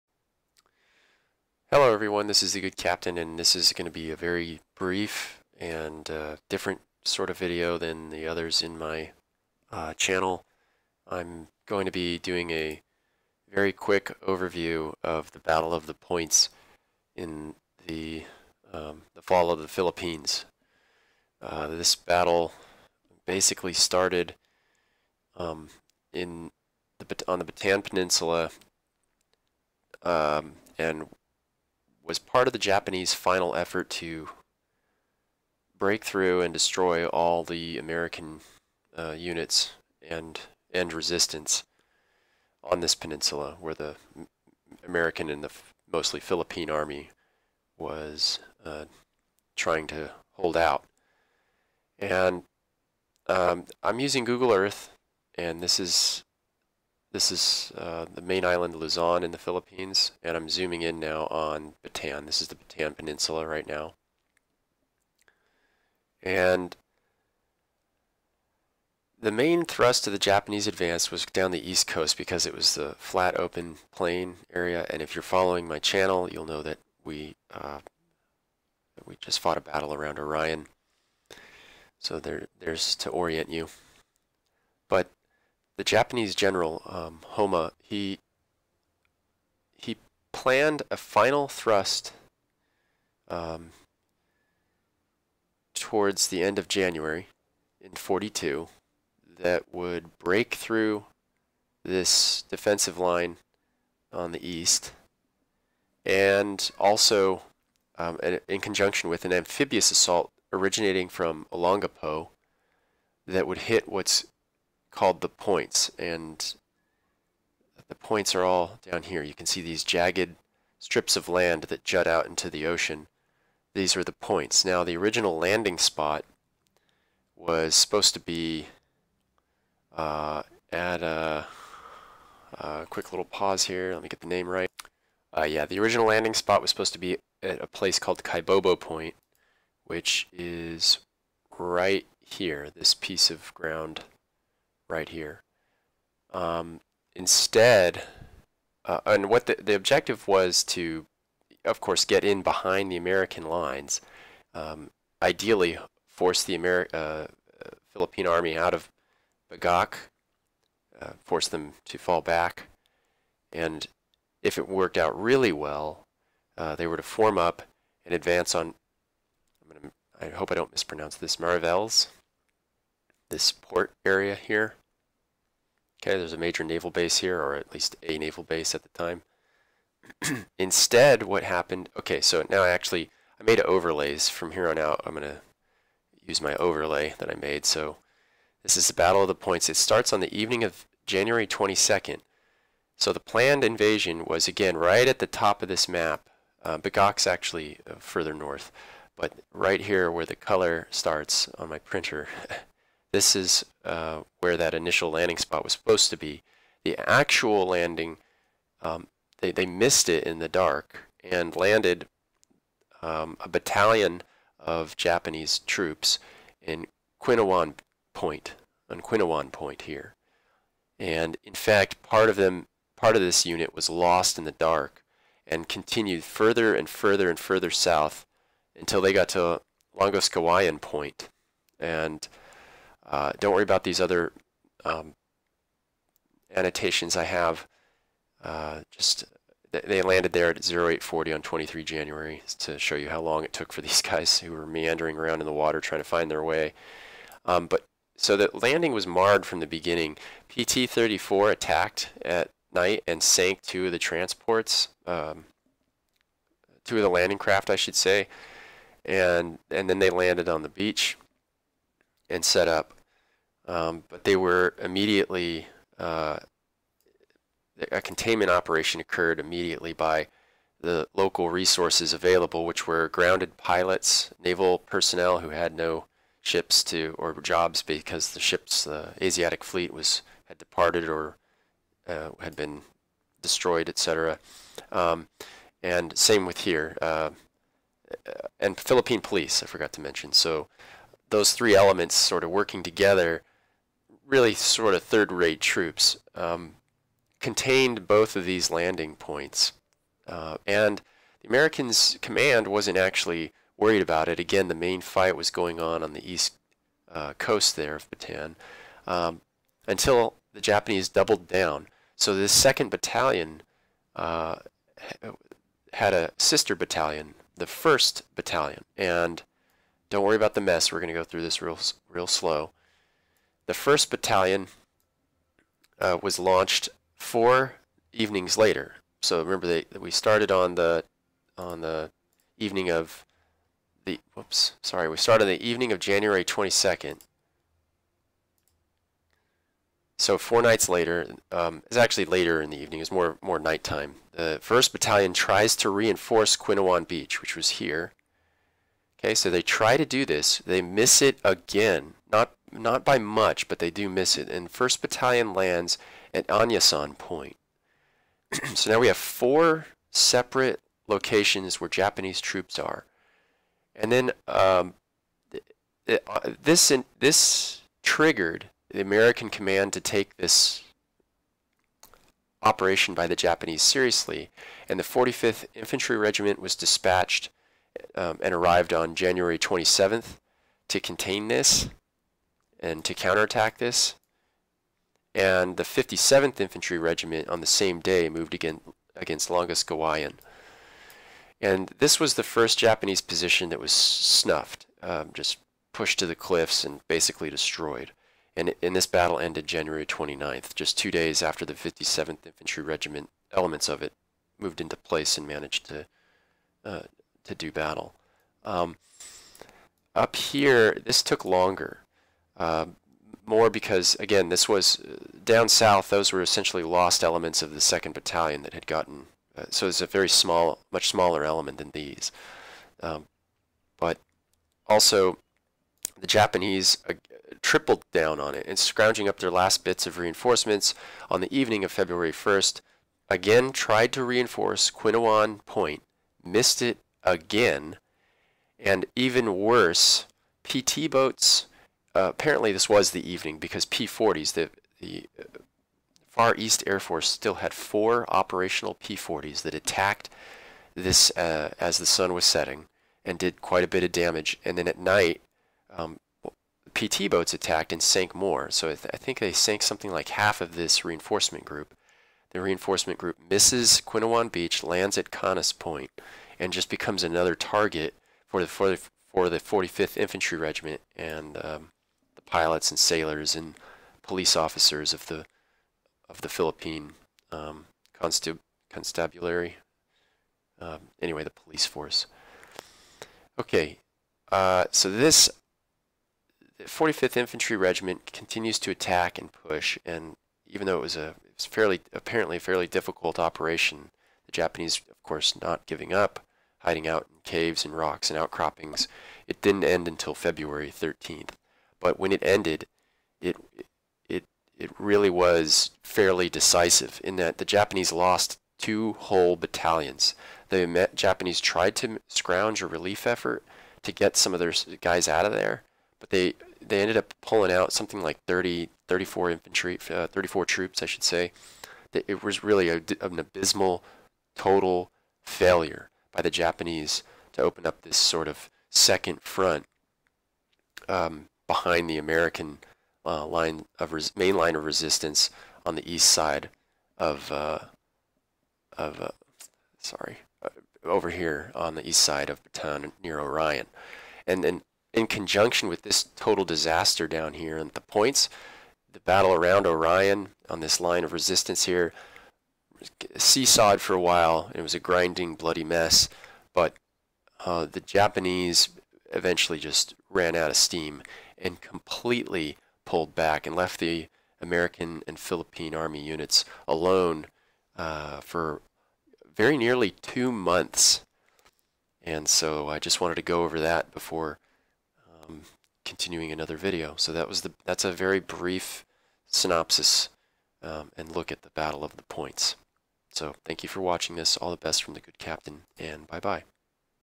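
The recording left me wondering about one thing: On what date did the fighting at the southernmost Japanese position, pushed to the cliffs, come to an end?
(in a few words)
January 29th.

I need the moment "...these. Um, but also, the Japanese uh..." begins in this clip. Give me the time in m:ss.
7:01.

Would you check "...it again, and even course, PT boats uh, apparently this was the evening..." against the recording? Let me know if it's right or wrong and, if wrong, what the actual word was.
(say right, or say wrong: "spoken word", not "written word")
wrong: "worse", not "course".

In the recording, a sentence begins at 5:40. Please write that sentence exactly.
So four nights later, um, it's actually later in the evening.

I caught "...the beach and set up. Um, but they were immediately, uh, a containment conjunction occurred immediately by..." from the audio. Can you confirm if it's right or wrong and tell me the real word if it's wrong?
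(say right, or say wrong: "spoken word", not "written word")
wrong: "operation", not "conjunction".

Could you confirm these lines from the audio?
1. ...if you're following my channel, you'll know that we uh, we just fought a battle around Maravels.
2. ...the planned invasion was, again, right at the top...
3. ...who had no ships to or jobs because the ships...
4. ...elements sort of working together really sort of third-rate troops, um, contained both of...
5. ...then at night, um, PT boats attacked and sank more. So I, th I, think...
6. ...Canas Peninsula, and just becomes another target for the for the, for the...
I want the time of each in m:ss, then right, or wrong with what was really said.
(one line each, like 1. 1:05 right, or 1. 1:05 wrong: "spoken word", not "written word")
1. 1:15 wrong: "Orion", not "Maravels"
2. 3:13 right
3. 4:35 right
4. 4:51 right
5. 7:34 right
6. 7:45 wrong: "Point", not "Peninsula".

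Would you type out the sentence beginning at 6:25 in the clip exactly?
And the 57th Infantry Regiment on the same day moved again against Longoskawayan.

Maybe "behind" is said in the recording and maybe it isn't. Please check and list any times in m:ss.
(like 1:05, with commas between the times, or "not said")
2:32, 8:51.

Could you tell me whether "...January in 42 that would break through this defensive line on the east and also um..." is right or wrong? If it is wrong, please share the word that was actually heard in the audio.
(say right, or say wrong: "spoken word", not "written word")
right.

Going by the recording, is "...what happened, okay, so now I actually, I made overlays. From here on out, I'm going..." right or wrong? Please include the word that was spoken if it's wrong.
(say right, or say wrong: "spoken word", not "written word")
right.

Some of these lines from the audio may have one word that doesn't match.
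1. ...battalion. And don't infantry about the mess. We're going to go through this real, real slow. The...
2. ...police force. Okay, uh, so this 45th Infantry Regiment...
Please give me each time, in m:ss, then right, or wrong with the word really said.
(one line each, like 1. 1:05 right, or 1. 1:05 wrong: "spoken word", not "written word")
1. 5:18 wrong: "worry", not "infantry"
2. 8:01 right.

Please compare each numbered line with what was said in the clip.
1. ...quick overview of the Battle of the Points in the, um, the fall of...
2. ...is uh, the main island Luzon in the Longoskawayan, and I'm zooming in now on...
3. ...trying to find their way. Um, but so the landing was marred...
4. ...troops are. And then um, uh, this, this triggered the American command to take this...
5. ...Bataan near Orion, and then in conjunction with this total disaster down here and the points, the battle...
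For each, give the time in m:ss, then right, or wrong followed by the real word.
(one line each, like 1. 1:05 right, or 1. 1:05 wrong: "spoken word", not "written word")
1. 0:13 right
2. 0:57 wrong: "Philippines", not "Longoskawayan"
3. 4:05 right
4. 6:02 right
5. 9:02 right.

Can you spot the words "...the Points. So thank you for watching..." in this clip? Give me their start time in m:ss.
9:42.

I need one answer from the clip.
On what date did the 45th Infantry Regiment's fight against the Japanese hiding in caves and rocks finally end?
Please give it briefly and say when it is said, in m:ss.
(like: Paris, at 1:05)
February 13th, at 8:20.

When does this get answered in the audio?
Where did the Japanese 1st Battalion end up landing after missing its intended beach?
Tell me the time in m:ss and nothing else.
5:56.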